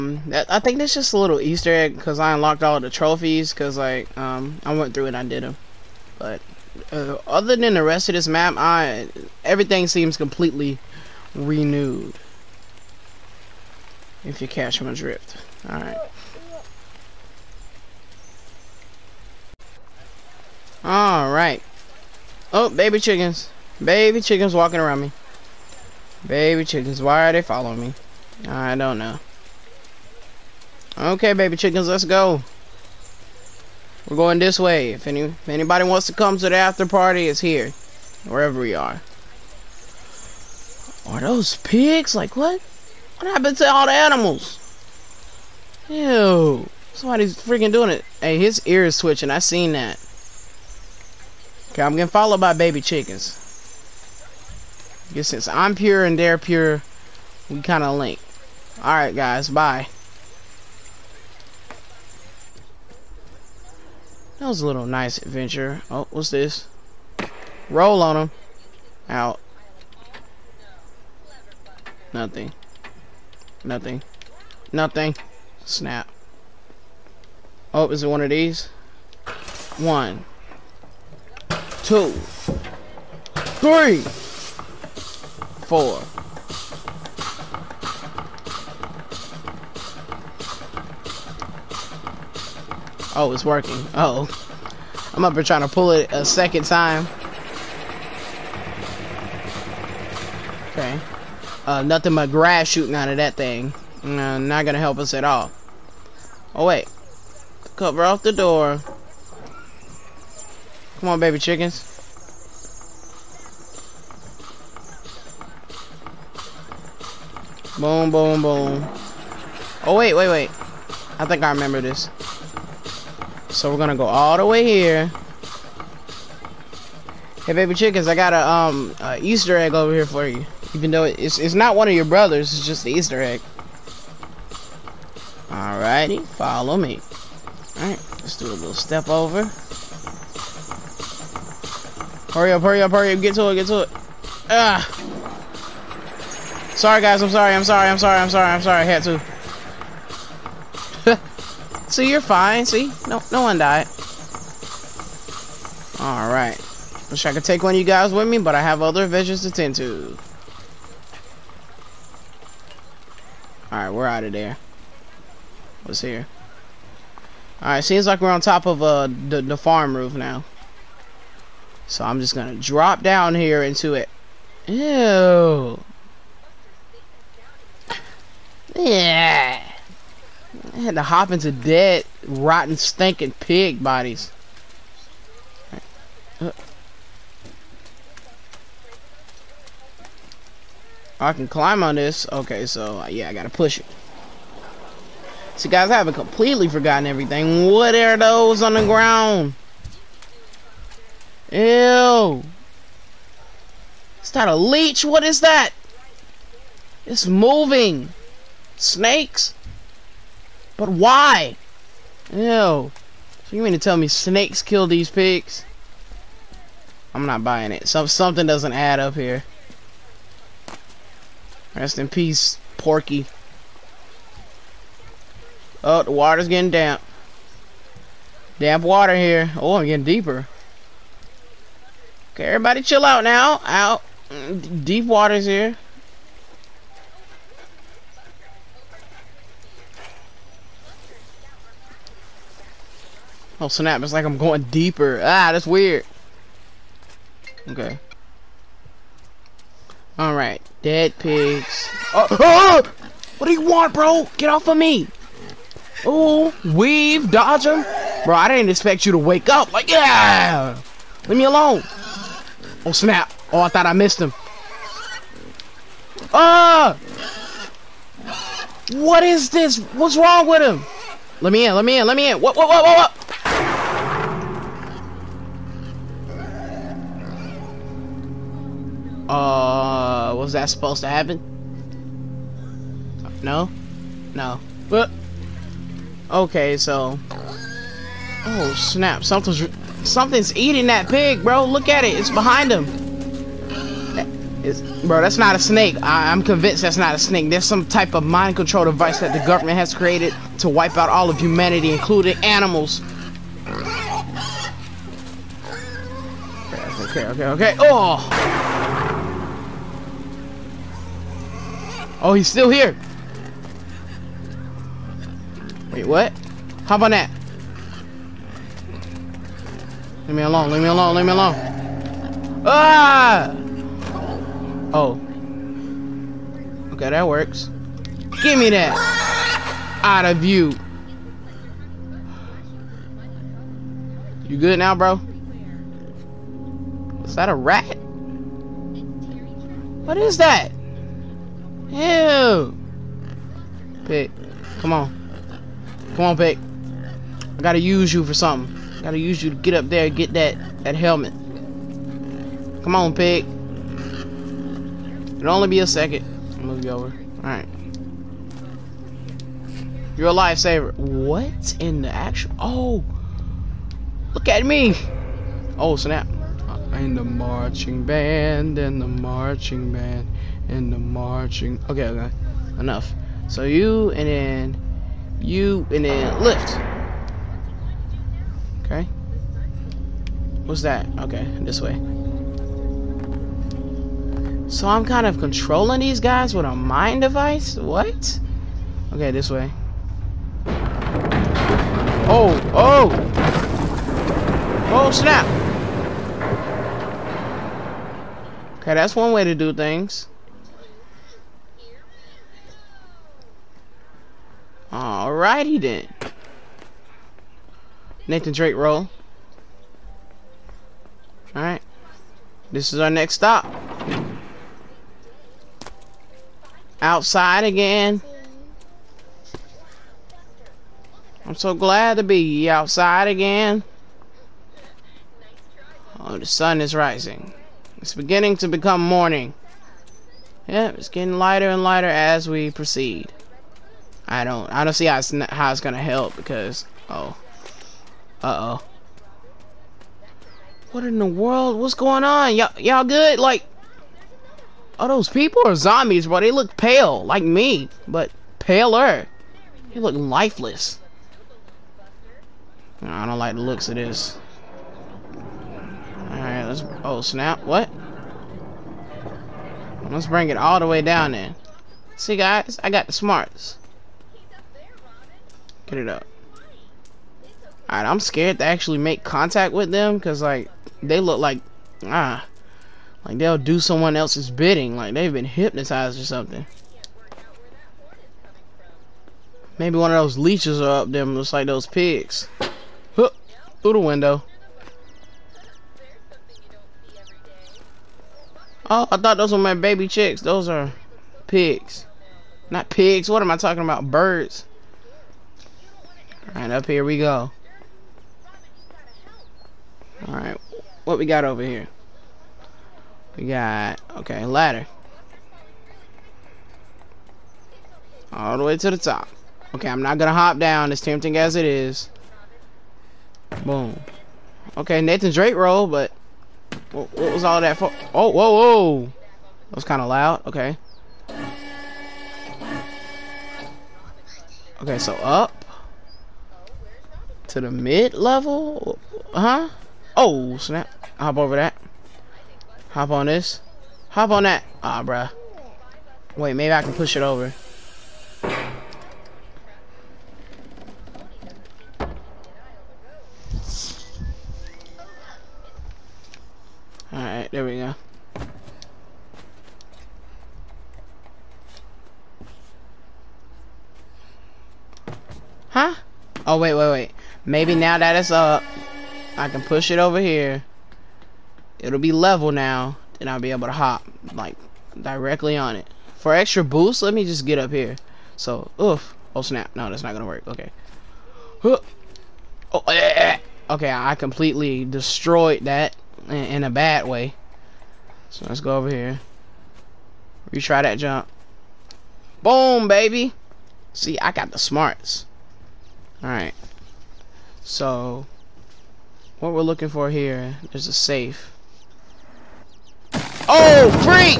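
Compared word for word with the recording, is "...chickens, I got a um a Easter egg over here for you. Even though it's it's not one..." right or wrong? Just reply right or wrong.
right.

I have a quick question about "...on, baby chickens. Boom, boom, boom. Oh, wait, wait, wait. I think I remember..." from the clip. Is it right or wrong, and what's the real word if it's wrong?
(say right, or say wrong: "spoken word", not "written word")
right.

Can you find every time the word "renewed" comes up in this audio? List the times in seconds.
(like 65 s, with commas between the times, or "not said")
11 s.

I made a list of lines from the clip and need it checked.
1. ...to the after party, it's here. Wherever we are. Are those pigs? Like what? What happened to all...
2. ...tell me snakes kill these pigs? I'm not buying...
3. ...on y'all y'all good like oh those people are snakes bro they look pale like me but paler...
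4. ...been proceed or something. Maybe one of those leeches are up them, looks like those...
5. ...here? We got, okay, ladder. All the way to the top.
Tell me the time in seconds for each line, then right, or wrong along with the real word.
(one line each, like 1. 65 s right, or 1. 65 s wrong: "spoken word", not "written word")
1. 36 s right
2. 213 s right
3. 442 s wrong: "zombies", not "snakes"
4. 475 s wrong: "hypnotized", not "proceed"
5. 501 s right.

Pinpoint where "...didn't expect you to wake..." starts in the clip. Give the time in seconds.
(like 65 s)
258 s.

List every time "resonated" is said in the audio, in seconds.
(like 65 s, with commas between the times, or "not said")
not said.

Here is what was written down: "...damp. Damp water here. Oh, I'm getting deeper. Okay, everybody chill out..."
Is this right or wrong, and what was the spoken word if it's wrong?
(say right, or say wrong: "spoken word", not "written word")
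right.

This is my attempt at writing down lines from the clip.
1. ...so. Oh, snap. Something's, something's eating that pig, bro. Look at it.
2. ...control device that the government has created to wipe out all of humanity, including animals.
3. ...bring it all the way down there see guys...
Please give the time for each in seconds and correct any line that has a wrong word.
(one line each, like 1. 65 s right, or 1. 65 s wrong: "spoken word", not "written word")
1. 286 s right
2. 298 s right
3. 460 s right.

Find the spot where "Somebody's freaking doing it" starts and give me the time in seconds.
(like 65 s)
46 s.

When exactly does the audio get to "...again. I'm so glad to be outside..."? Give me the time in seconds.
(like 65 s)
417 s.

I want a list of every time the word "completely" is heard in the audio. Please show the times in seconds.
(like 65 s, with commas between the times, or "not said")
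10 s, 196 s, 574 s.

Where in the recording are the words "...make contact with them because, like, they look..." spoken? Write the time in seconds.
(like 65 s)
468 s.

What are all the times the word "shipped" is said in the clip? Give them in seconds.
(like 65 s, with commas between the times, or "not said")
not said.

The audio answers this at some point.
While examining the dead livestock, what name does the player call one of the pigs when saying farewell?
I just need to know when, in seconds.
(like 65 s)
222 s.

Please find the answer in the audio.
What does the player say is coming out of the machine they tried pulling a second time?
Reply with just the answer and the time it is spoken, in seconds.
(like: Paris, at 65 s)
Grass, at 102 s.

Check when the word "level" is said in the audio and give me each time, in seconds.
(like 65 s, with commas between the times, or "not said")
528 s, 562 s.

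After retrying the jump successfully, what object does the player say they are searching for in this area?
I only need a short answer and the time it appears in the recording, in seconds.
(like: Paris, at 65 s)
A safe, at 590 s.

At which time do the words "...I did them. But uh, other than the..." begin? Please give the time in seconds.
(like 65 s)
5 s.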